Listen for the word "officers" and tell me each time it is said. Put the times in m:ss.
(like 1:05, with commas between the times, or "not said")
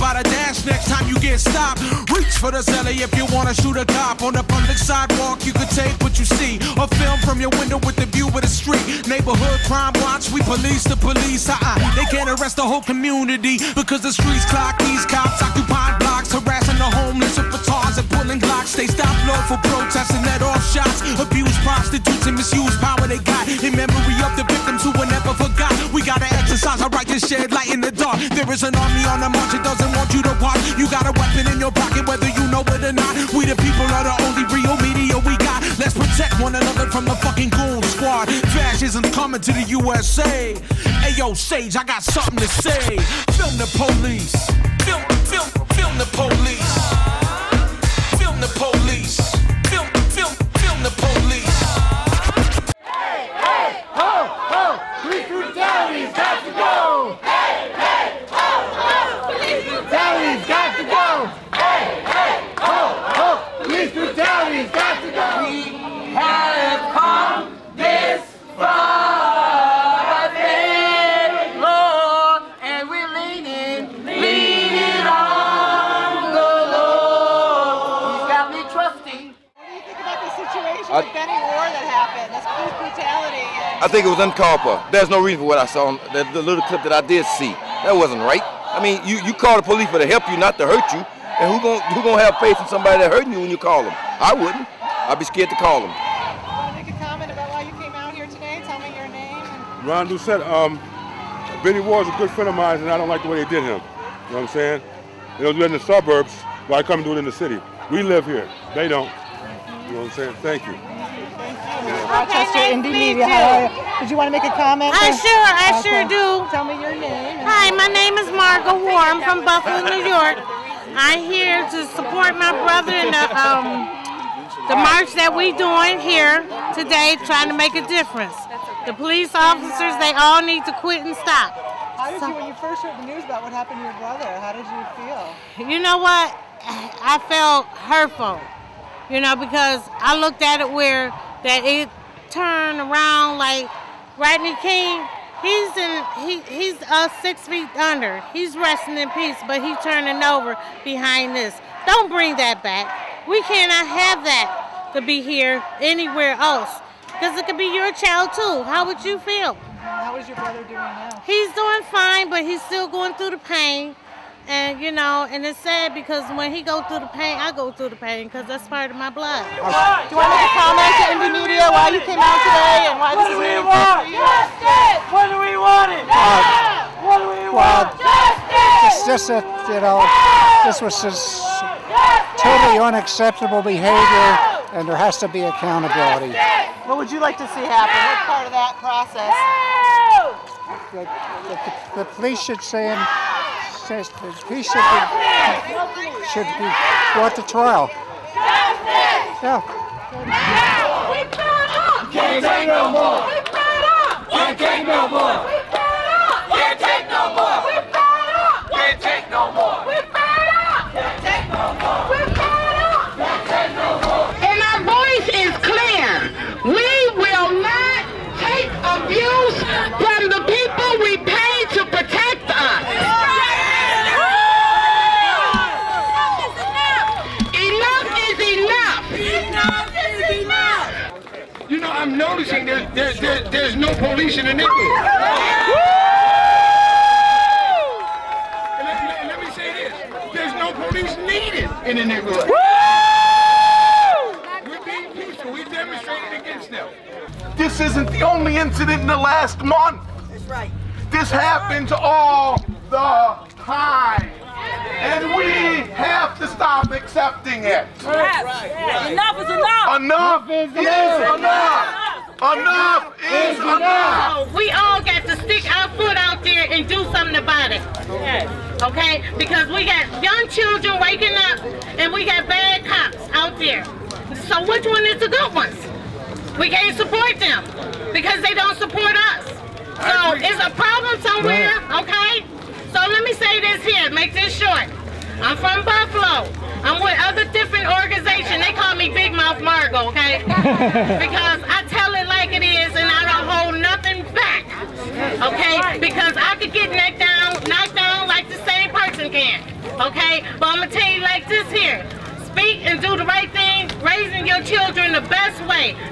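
2:09.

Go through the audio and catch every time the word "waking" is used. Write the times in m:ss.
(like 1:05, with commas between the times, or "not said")
4:31.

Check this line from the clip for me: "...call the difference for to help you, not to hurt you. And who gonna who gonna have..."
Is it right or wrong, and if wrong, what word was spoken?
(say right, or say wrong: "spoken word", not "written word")
wrong: "police", not "difference".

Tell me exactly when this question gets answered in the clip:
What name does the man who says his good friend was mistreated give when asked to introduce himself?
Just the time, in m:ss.
1:39.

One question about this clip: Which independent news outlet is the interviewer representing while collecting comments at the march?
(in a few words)
Indymedia.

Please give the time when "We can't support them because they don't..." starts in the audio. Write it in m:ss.
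4:36.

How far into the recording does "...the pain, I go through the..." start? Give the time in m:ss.
2:47.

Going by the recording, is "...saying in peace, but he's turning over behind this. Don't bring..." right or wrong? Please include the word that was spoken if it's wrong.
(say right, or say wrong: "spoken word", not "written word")
wrong: "resting", not "saying".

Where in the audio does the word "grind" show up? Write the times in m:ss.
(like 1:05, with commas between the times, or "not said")
not said.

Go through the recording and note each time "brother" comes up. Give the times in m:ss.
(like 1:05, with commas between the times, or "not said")
2:02, 2:13, 2:40.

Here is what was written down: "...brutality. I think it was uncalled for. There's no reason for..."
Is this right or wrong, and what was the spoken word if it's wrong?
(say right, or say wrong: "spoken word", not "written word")
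right.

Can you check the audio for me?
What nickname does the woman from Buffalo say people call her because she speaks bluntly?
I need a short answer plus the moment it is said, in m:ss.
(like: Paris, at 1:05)
Big Mouth Margo, at 4:49.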